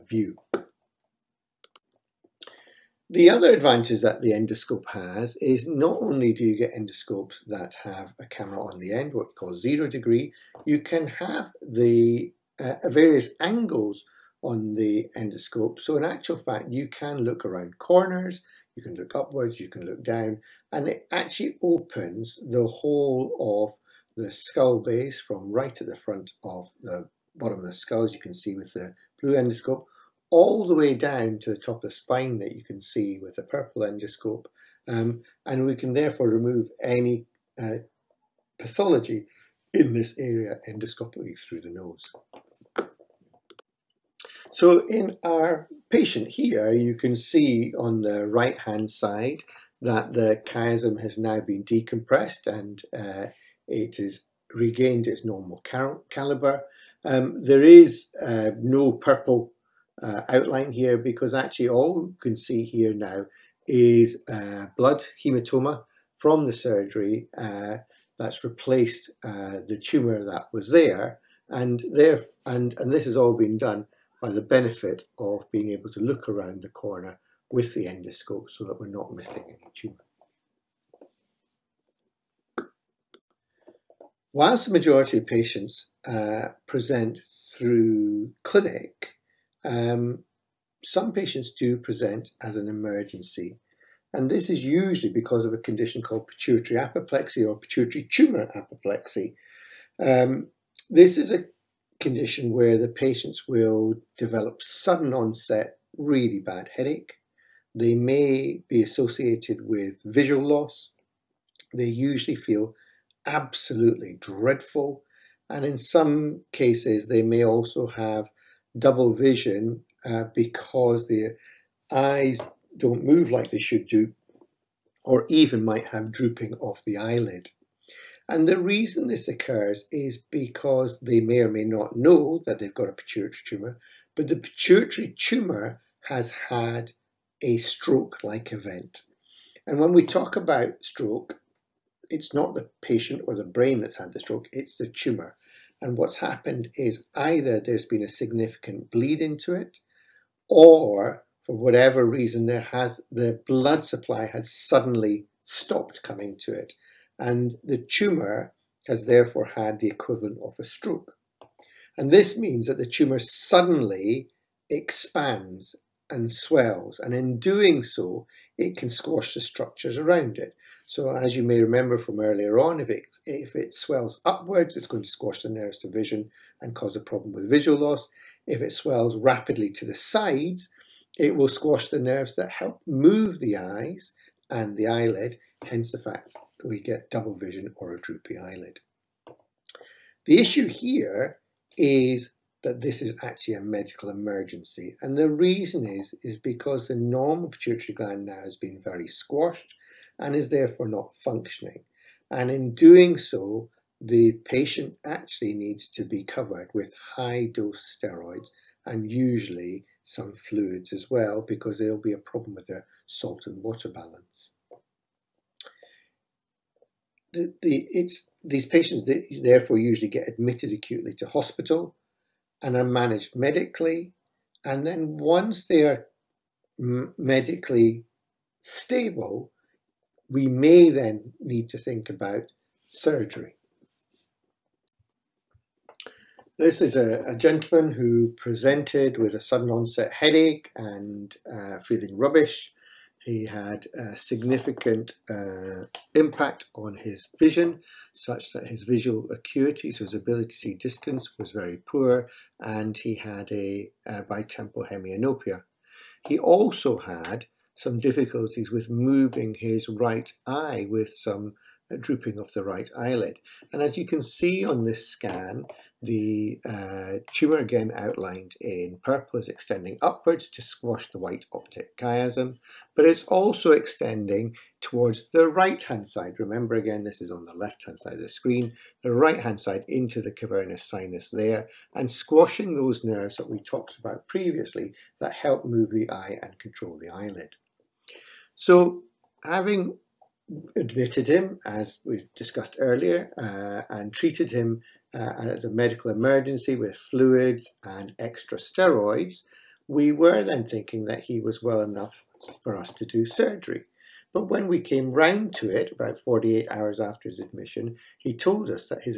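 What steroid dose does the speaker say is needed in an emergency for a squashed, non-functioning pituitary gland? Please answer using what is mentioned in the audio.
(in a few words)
high dose.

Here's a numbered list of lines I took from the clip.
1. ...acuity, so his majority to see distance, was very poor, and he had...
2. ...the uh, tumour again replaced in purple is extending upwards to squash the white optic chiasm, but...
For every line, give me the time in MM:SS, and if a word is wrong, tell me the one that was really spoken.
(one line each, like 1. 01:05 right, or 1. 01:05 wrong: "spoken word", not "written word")
1. 04:09 wrong: "ability", not "majority"
2. 04:26 wrong: "outlined", not "replaced".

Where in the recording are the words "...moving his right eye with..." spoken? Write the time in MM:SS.
04:18.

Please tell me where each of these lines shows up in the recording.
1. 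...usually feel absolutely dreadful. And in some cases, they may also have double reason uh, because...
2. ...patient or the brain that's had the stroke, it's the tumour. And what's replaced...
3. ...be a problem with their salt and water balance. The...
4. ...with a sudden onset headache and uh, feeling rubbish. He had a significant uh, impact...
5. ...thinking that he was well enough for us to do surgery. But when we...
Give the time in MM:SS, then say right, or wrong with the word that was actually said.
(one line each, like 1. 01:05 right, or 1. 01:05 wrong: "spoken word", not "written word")
1. 01:51 wrong: "vision", not "reason"
2. 02:22 wrong: "happened", not "replaced"
3. 03:32 right
4. 03:59 right
5. 05:00 right.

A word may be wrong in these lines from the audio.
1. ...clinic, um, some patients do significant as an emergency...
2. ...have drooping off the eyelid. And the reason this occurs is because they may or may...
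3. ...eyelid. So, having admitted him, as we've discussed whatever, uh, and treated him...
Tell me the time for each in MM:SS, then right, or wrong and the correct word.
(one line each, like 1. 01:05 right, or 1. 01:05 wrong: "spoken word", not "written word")
1. 01:28 wrong: "present", not "significant"
2. 02:05 right
3. 04:47 wrong: "earlier", not "whatever".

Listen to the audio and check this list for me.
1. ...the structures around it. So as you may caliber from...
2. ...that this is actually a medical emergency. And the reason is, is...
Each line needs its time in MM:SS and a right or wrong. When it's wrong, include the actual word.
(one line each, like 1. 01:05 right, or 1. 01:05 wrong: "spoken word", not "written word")
1. 02:49 wrong: "remember", not "caliber"
2. 03:12 right.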